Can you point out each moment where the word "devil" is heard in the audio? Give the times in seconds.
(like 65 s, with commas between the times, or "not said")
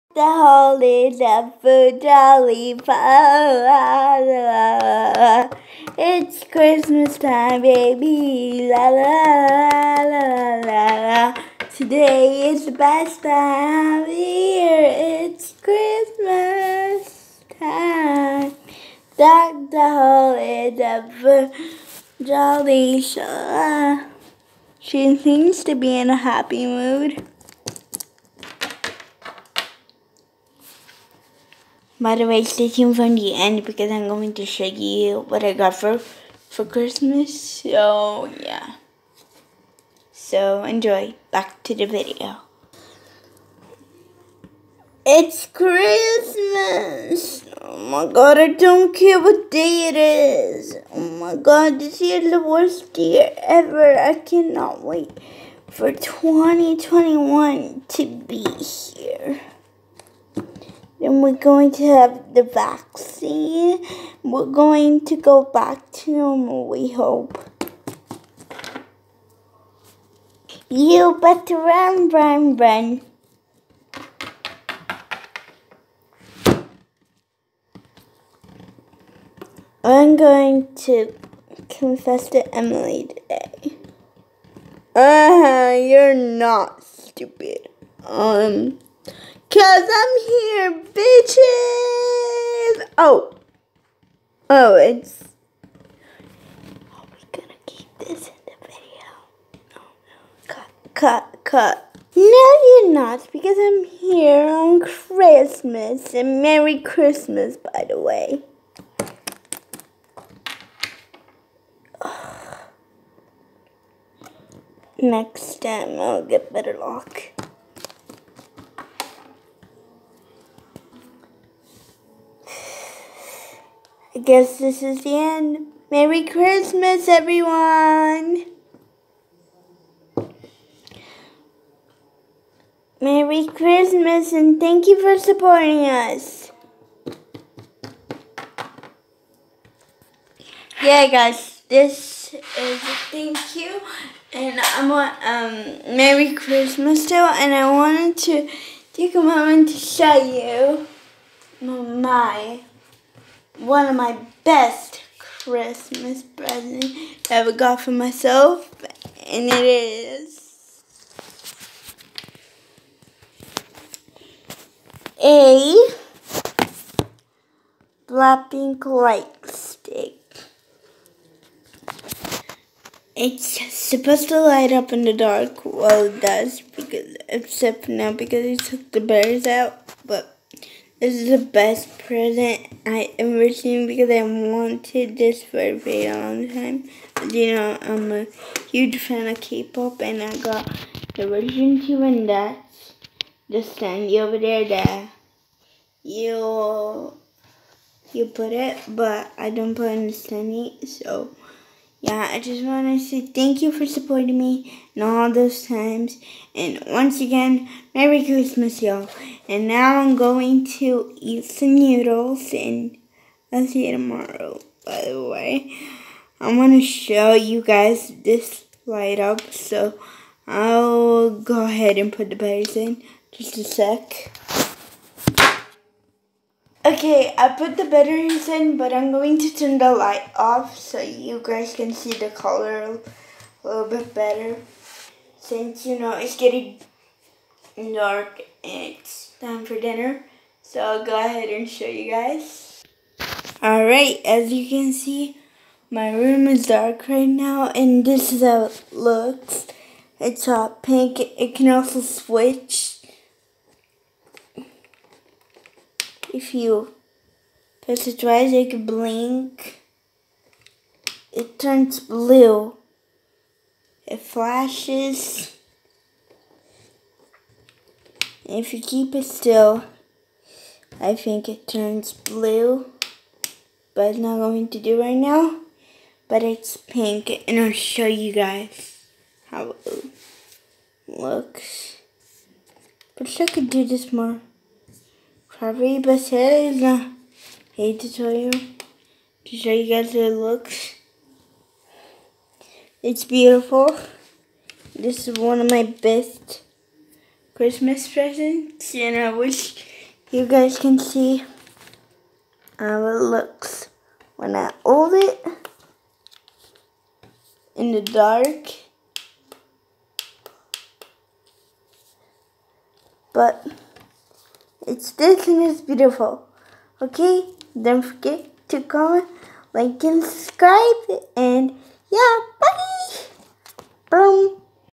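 1 s, 20 s.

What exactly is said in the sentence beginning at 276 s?
But it's pink, and I'll show you guys how it looks.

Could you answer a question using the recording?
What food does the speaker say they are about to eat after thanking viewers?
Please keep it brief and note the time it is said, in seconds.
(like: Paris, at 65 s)
noodles, at 211 s.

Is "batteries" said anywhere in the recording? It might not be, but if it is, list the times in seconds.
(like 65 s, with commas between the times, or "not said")
179 s, 222 s, 227 s.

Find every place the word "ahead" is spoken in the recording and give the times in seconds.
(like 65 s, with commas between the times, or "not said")
221 s, 241 s.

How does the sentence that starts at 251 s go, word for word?
It can also switch if you press it twice, it blink.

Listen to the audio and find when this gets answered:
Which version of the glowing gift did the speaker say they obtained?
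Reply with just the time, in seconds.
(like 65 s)
191 s.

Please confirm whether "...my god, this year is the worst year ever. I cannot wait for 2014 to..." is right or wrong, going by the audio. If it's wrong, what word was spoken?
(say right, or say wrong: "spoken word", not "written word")
wrong: "2021", not "2014".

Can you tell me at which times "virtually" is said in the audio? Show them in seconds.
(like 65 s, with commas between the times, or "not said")
not said.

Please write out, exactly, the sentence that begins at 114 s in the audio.
Next time, I'll get better luck.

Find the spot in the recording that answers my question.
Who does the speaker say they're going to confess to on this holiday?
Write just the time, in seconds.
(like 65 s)
82 s.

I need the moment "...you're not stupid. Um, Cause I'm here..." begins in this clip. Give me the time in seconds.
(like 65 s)
85 s.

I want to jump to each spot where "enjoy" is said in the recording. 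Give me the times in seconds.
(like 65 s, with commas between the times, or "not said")
40 s.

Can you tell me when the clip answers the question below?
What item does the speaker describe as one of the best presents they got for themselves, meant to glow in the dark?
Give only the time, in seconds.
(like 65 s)
168 s.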